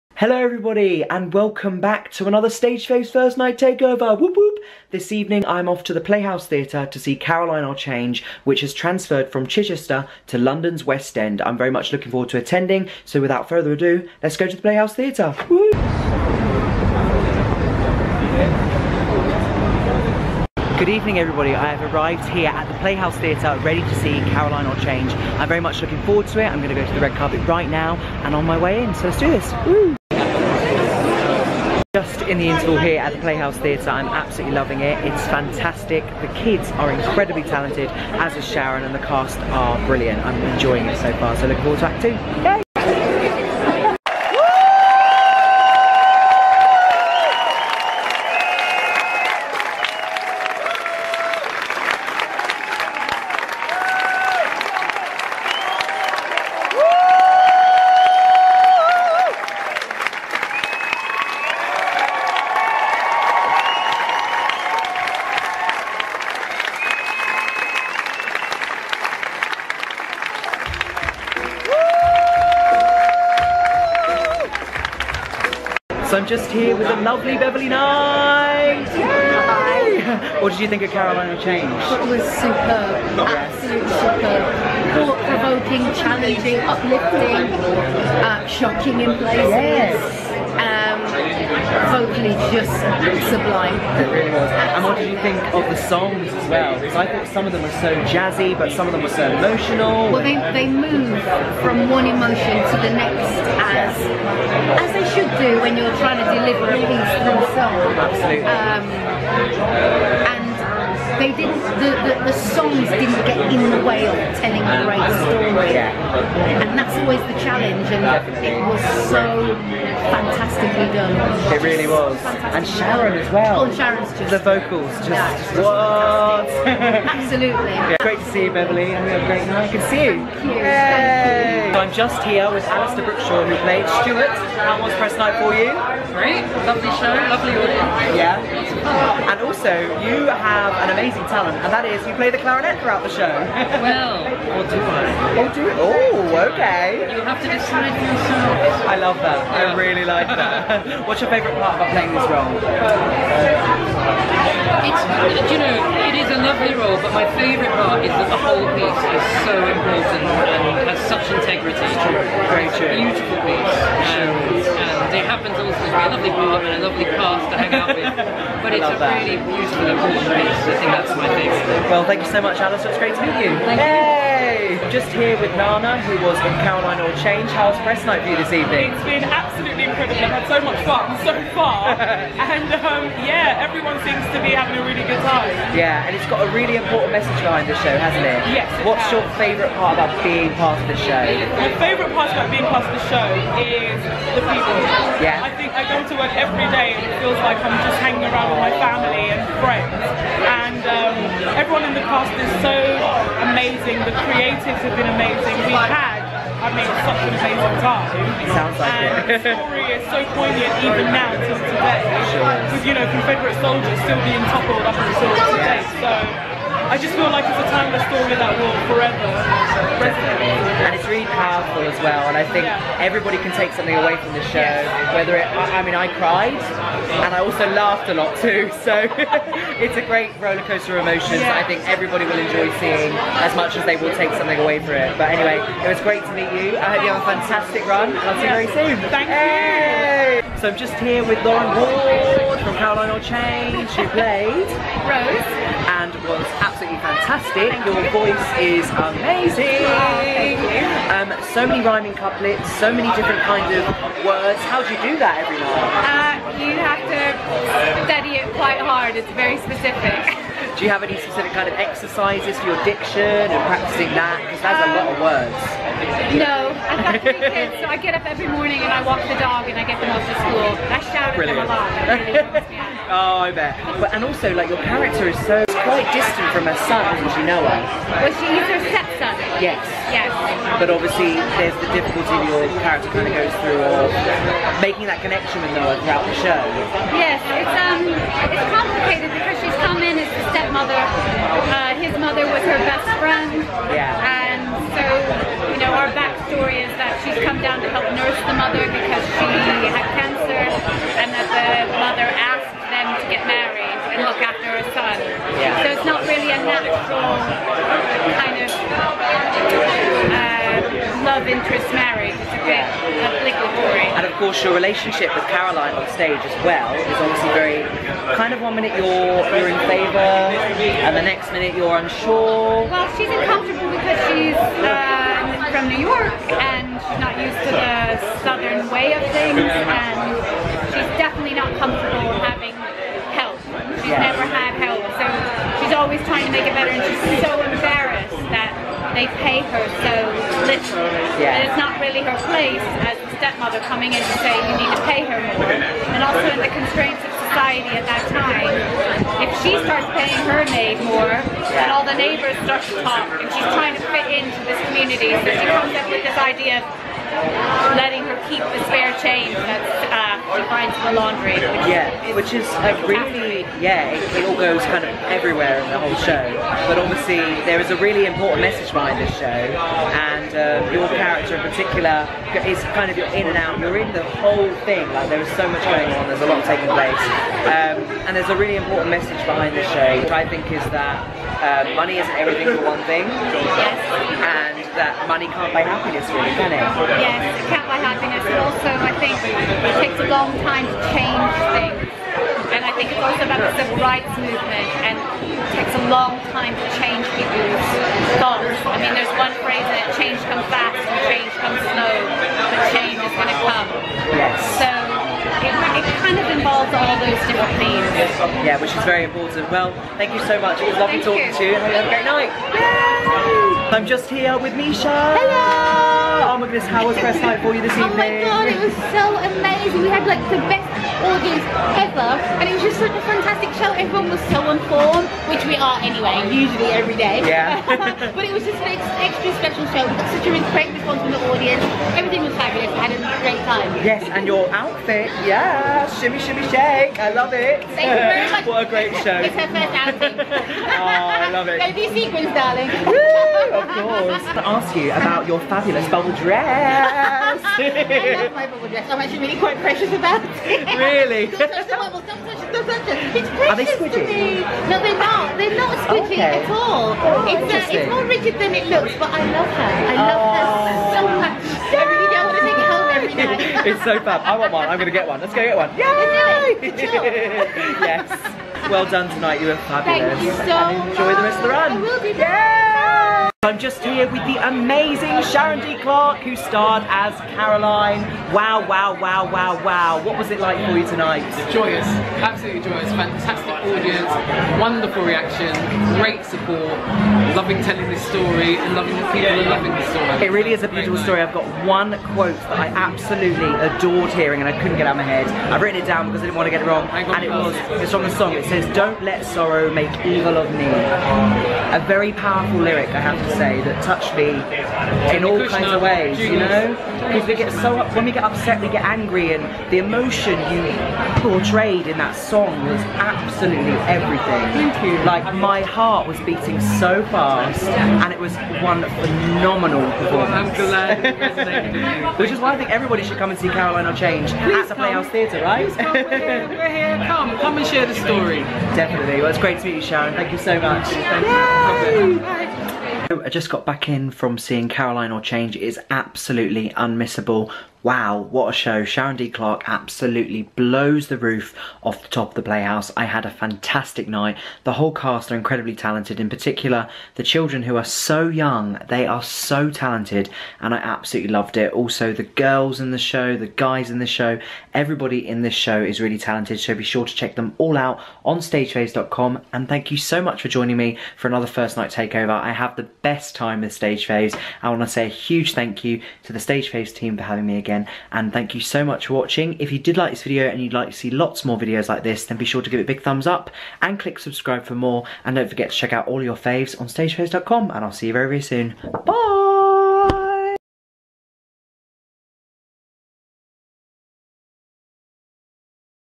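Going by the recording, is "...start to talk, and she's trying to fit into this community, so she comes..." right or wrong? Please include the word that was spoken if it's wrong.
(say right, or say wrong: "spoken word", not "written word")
right.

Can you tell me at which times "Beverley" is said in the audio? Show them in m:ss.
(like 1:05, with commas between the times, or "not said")
1:17, 2:08.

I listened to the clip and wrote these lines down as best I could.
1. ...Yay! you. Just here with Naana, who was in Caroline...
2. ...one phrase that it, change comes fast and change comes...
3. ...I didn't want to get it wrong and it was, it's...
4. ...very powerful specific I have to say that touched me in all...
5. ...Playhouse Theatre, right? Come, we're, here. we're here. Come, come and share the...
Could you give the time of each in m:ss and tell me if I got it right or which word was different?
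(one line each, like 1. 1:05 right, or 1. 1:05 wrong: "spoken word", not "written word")
1. 2:53 right
2. 6:39 right
3. 8:16 right
4. 8:22 wrong: "lyric", not "specific"
5. 8:44 right.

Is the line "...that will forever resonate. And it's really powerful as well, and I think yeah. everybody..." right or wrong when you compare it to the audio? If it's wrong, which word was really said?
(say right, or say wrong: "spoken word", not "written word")
right.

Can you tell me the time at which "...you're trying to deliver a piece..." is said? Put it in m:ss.
1:45.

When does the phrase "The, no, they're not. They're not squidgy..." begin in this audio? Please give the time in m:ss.
7:34.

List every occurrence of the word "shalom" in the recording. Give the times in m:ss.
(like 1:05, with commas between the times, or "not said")
not said.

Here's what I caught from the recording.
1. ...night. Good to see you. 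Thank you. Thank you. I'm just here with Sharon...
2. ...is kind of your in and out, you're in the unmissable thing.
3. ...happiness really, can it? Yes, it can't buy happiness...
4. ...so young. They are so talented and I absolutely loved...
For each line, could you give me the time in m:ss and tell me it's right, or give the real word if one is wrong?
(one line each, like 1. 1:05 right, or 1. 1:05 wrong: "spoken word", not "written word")
1. 2:09 wrong: "Alastair", not "Sharon"
2. 6:12 wrong: "whole", not "unmissable"
3. 6:25 right
4. 9:08 right.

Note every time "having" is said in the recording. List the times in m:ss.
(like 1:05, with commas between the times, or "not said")
3:04, 9:27.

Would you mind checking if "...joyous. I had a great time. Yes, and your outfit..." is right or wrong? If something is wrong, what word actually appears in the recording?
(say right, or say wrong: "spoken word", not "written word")
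wrong: "fabulous", not "joyous".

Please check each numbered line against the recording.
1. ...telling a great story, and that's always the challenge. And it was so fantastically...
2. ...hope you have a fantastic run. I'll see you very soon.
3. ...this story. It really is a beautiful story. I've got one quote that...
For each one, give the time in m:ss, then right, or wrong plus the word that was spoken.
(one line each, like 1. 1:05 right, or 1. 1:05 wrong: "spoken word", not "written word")
1. 1:54 right
2. 3:56 right
3. 8:09 right.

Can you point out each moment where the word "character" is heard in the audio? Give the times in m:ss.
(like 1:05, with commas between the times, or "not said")
4:34, 4:42, 6:11.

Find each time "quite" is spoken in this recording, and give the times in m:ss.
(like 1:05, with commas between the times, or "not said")
4:18, 4:35, 7:29.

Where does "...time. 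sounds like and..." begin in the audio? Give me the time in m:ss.
3:27.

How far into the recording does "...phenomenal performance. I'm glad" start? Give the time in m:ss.
8:39.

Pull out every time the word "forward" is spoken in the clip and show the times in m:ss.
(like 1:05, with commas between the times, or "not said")
0:12, 0:26, 0:41.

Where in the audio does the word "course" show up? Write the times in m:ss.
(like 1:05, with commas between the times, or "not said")
5:14, 7:23.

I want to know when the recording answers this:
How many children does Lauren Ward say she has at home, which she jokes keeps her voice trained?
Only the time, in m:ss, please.
4:27.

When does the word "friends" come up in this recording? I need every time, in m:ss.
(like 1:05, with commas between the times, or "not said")
3:19, 4:53.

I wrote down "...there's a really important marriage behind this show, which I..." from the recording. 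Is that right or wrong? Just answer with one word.
wrong.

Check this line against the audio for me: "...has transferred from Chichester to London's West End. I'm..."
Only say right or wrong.
right.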